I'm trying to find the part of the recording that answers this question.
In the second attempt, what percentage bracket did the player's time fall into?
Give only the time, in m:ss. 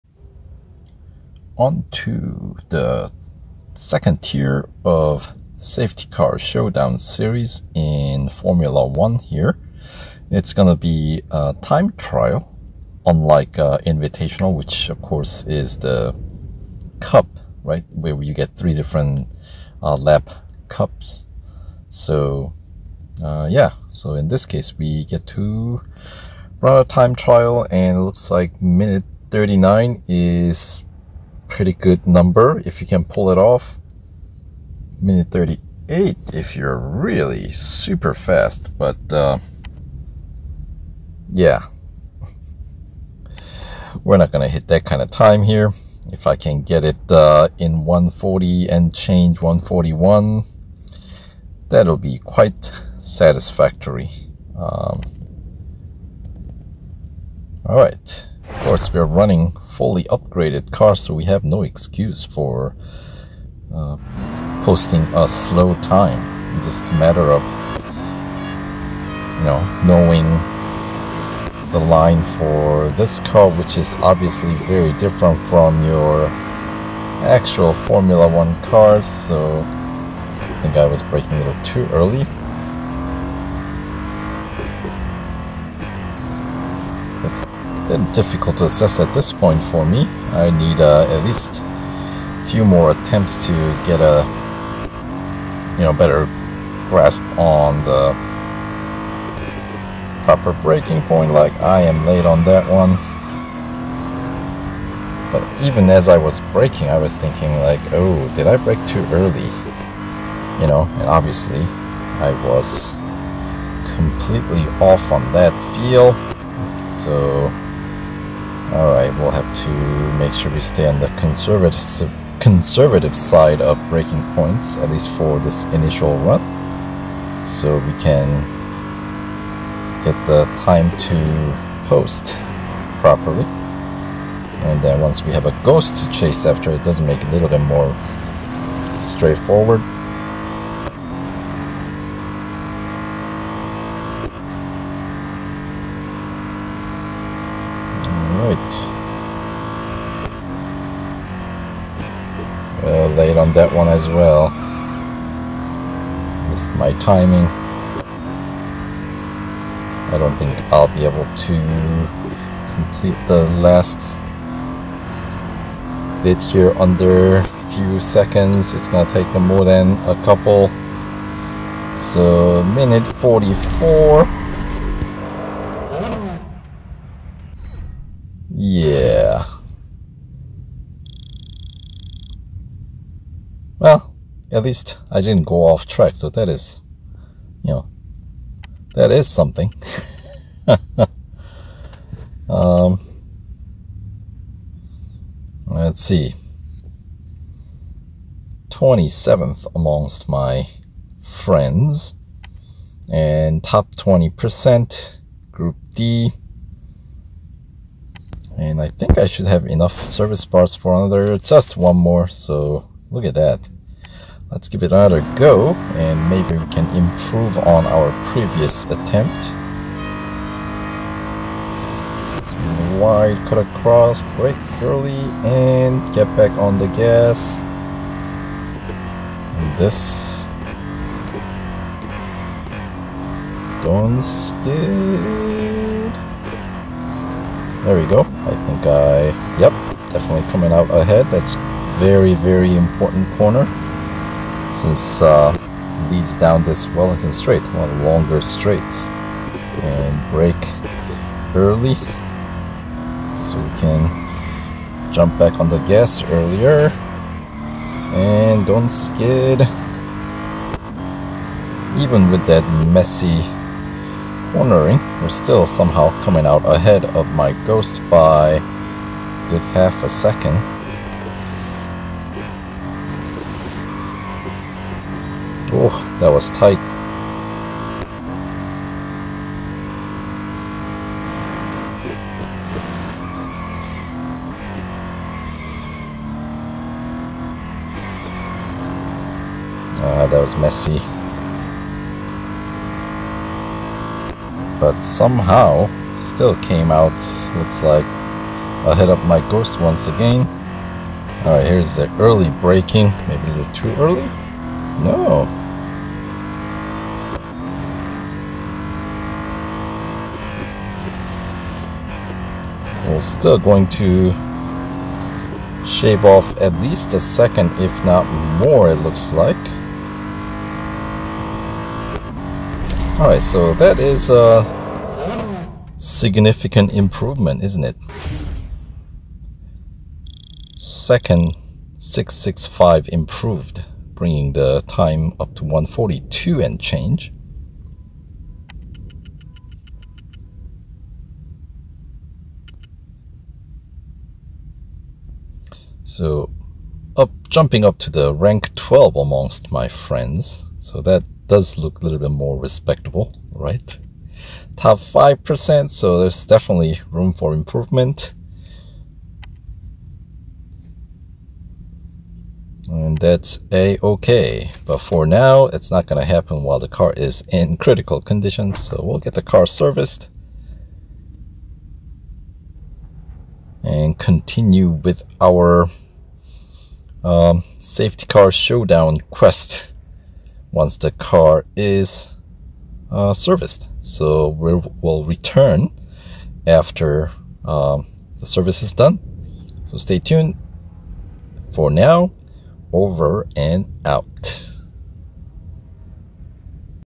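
5:54.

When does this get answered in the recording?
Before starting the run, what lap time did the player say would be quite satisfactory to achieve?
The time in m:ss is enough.
0:47.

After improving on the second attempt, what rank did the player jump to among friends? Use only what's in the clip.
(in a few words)
12.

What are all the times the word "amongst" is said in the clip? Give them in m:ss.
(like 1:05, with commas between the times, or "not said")
3:19, 5:49.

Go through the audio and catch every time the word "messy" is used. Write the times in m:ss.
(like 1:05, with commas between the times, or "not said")
4:22, 4:50.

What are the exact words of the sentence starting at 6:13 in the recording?
and continue with our um, safety car showdown quest once the car is uh, serviced.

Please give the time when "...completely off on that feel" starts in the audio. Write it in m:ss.
1:53.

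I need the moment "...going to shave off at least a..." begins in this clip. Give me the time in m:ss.
5:13.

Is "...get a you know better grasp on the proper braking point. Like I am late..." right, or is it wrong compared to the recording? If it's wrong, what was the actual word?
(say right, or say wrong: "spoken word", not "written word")
right.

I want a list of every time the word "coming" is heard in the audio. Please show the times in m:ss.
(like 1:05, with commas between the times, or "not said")
4:00, 4:26.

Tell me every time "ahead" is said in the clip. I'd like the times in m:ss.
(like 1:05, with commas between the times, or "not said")
4:00, 4:26.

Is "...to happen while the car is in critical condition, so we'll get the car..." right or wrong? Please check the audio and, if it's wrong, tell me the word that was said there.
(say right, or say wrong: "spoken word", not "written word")
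right.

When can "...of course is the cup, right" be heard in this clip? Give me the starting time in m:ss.
0:14.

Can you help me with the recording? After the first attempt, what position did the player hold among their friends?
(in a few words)
27th.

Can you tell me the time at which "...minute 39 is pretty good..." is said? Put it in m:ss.
0:28.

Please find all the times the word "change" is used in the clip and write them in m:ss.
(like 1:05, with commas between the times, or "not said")
0:48, 5:36.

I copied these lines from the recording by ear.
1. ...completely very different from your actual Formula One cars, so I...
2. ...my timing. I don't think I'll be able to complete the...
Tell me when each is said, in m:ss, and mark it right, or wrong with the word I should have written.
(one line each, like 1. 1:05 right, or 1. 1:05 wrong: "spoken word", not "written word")
1. 1:13 wrong: "obviously", not "completely"
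2. 2:36 right.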